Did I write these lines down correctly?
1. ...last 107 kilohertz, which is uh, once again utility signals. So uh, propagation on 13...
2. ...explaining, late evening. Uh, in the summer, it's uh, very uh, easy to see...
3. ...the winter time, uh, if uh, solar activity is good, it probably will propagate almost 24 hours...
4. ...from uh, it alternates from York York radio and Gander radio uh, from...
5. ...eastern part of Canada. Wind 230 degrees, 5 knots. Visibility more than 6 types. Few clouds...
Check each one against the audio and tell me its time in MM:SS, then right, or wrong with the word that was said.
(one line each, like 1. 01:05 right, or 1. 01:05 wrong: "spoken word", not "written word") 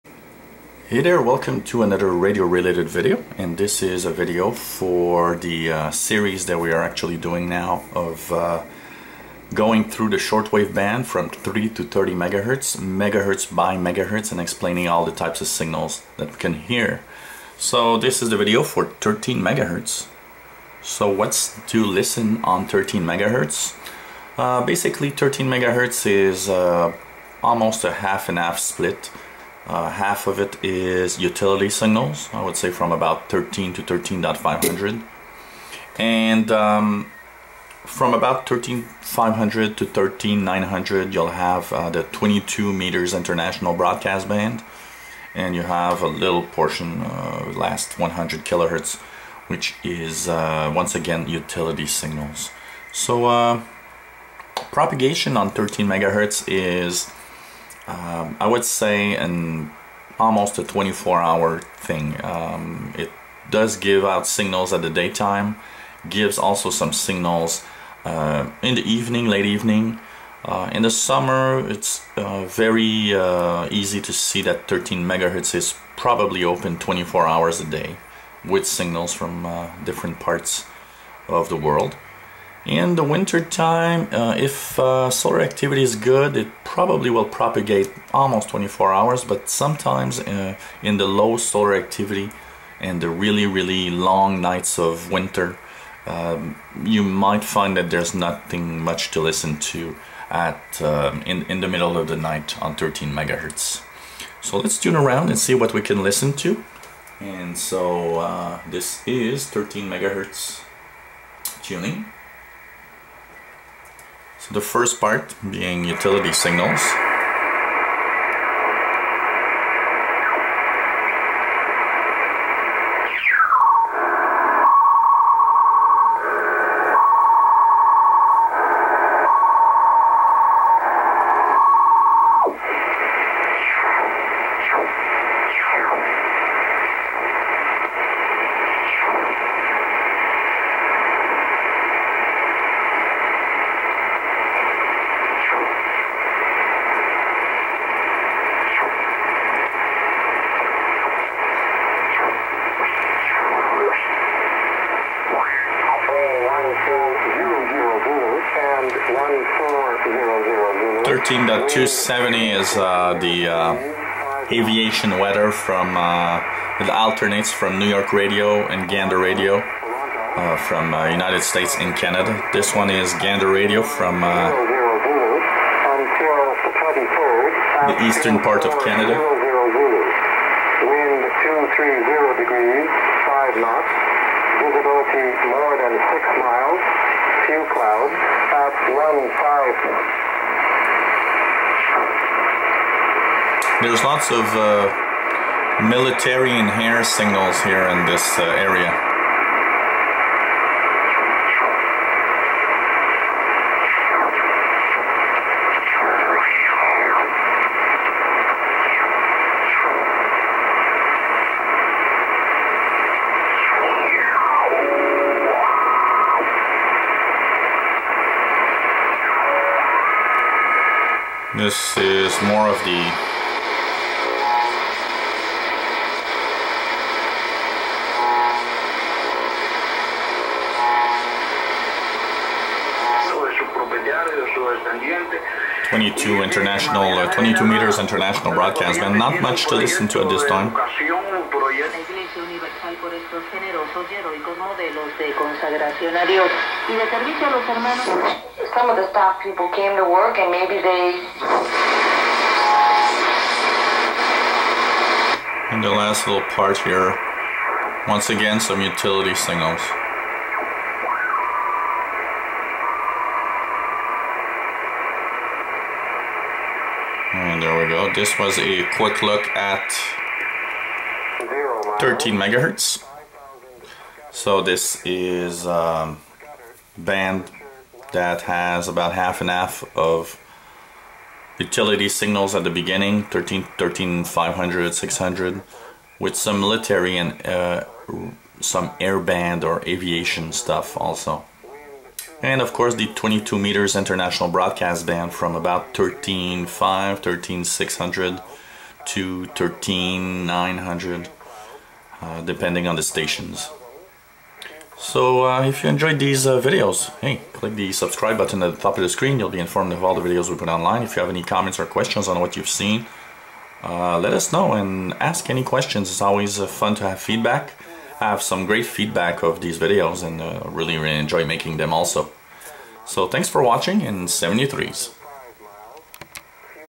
1. 00:47 wrong: "100", not "107"
2. 01:08 wrong: "evening", not "explaining"
3. 01:22 right
4. 02:45 wrong: "New", not "York"
5. 02:58 wrong: "miles", not "types".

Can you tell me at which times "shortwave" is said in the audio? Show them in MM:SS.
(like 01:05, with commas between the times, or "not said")
00:10.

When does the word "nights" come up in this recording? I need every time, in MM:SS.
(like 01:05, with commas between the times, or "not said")
01:34, 01:42.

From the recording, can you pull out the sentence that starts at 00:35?
And um, from about 13,500 to 13,900, you'll have uh, the 22 meters international broadcast band.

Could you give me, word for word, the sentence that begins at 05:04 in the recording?
So uh, if you enjoyed these uh, videos, hey, click the subscribe button at the top of the screen.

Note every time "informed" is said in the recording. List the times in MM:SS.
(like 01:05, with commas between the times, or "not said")
05:09.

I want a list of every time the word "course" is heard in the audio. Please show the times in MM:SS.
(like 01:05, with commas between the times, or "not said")
04:52.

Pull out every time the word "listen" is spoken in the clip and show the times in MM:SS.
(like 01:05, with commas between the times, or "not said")
00:21, 01:39, 01:46, 03:59.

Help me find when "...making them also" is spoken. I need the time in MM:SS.
05:21.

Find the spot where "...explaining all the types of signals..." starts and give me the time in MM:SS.
00:14.